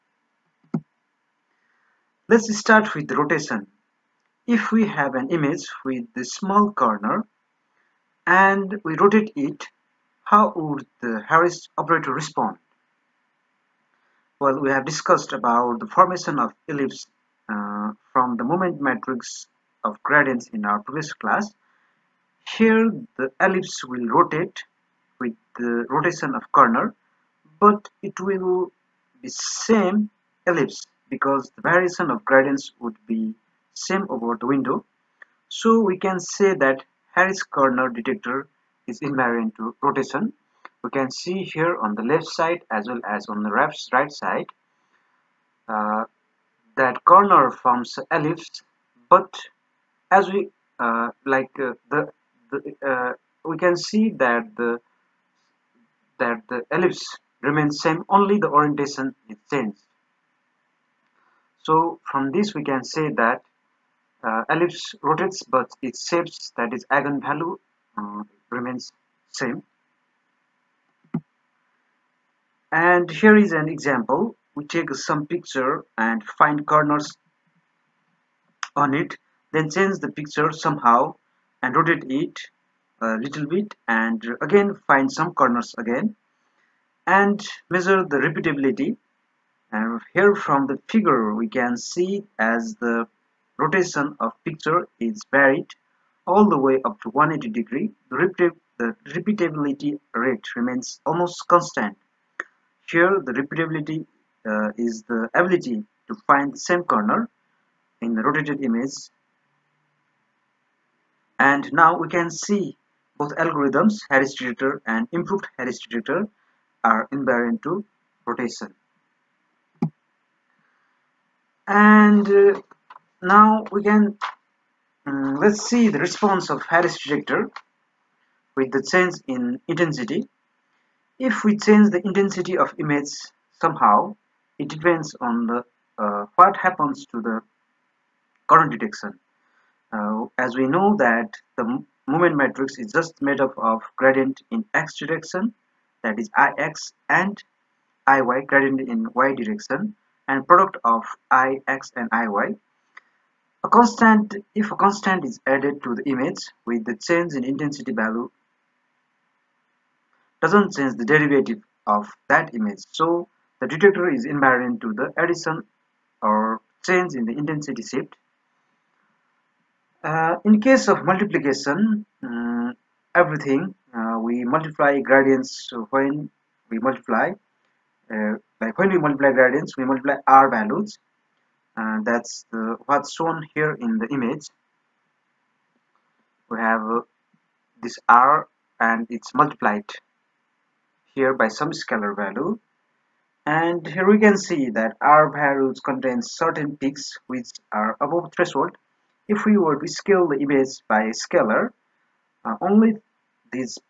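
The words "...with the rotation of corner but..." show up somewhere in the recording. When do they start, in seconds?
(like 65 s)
25 s.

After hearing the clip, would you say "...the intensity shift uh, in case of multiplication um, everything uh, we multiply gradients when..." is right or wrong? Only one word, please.
right.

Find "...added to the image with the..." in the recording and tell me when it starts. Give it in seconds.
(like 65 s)
155 s.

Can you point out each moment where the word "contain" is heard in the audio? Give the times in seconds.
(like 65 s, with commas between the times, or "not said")
195 s.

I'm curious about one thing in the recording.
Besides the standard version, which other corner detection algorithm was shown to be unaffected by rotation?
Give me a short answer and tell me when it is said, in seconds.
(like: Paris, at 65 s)
improved Harris detector, at 115 s.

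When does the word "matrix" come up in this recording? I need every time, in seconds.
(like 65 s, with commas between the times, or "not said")
18 s, 142 s.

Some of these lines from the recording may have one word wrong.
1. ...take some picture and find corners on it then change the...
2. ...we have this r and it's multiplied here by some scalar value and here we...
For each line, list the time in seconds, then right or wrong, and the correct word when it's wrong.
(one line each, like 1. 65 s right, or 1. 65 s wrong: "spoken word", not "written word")
1. 74 s right
2. 186 s right.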